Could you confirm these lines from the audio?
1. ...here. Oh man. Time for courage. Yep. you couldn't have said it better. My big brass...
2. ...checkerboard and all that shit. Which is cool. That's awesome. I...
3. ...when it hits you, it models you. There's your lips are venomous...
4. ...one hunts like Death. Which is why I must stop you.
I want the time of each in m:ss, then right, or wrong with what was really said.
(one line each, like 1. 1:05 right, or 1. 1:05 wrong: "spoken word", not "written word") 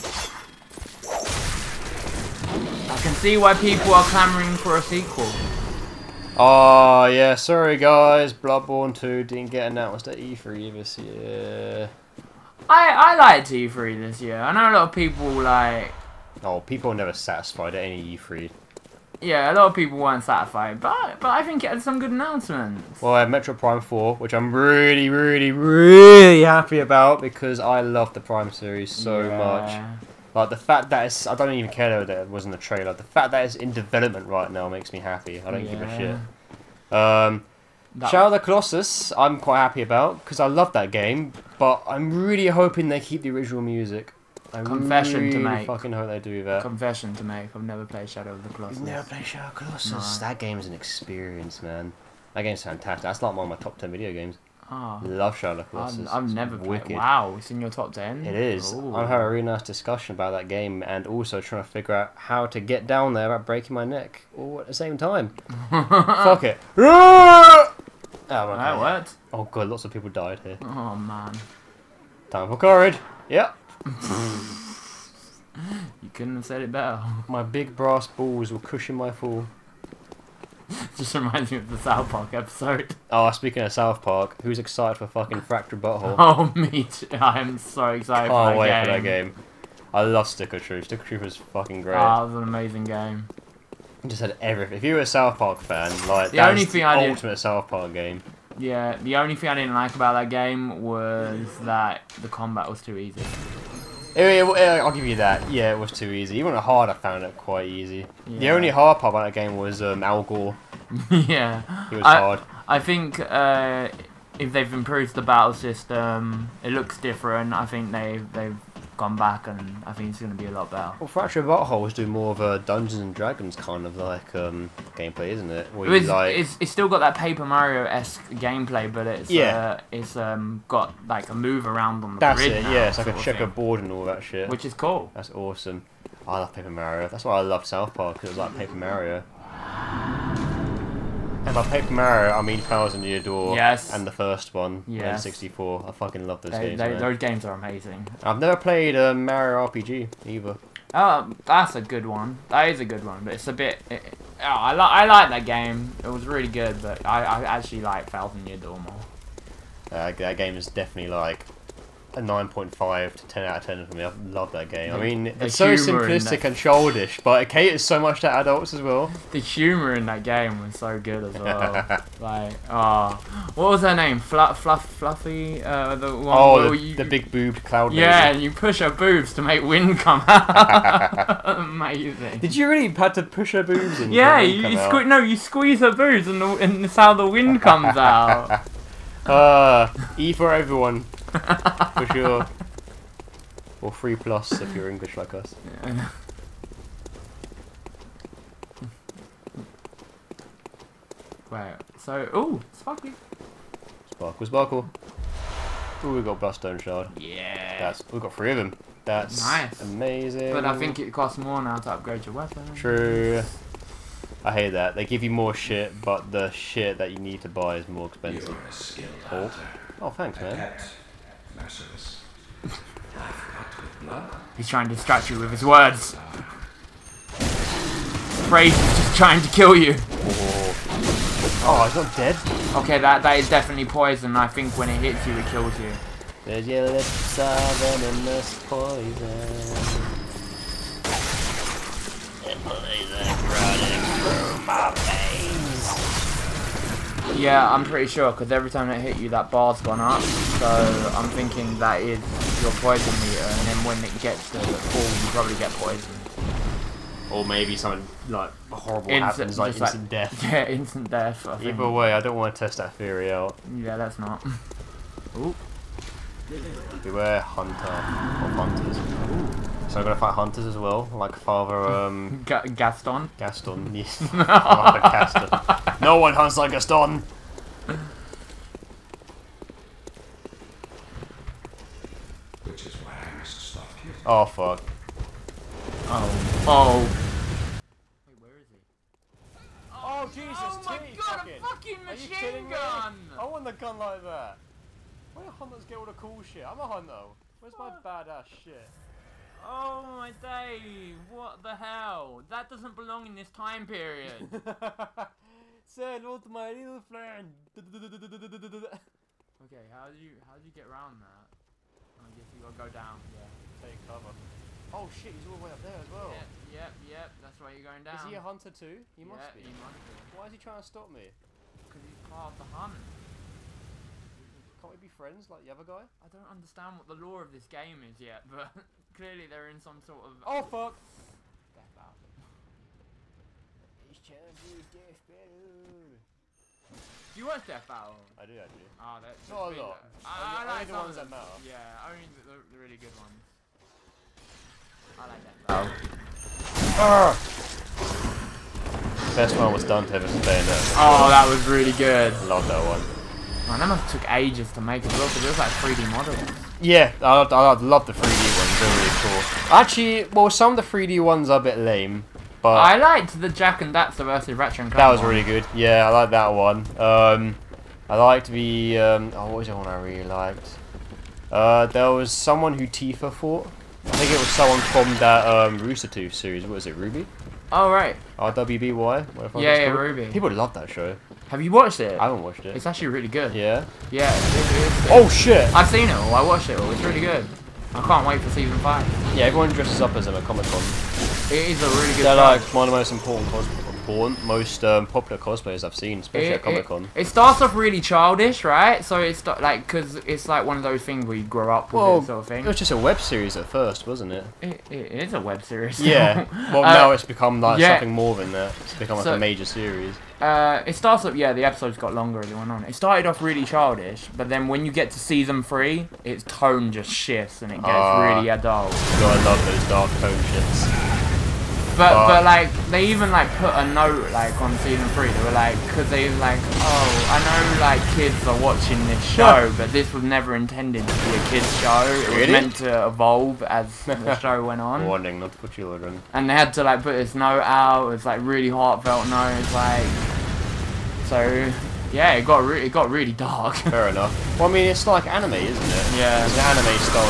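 1. 1:10 right
2. 2:13 right
3. 3:54 wrong: "kills", not "models"
4. 4:36 wrong: "Gaston", not "Death".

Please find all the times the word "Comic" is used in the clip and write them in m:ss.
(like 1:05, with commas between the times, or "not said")
6:30, 6:36.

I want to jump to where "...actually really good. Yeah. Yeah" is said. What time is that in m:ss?
6:22.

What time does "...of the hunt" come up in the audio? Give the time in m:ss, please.
5:22.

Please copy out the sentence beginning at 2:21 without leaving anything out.
And by Paper Mario, I mean Thousand Year Door.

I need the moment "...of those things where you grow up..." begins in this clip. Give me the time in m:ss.
6:40.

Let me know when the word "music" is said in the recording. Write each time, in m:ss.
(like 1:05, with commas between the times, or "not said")
0:43.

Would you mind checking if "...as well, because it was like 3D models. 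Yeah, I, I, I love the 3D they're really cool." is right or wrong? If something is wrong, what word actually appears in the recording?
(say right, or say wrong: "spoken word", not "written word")
right.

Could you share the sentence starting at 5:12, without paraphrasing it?
I guess you gotta go down.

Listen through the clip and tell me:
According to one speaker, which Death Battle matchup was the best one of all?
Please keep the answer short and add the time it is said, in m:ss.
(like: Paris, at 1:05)
Dante vs Bayonetta, at 5:49.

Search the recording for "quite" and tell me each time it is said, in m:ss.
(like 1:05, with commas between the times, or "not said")
0:39, 1:47.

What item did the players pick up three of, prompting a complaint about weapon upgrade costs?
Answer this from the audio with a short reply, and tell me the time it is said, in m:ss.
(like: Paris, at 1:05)
Blood Stone Shard, at 3:26.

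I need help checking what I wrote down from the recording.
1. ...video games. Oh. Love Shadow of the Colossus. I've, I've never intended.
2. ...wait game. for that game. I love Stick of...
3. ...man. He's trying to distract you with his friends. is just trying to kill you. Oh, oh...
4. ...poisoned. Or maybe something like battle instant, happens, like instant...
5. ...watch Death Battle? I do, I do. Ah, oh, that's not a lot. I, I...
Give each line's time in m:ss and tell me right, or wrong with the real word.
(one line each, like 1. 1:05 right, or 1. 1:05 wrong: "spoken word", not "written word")
1. 0:53 wrong: "wicked", not "intended"
2. 1:28 right
3. 3:40 wrong: "words", not "friends"
4. 4:15 wrong: "horrible", not "battle"
5. 5:37 right.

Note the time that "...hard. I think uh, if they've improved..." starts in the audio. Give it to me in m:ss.
1:52.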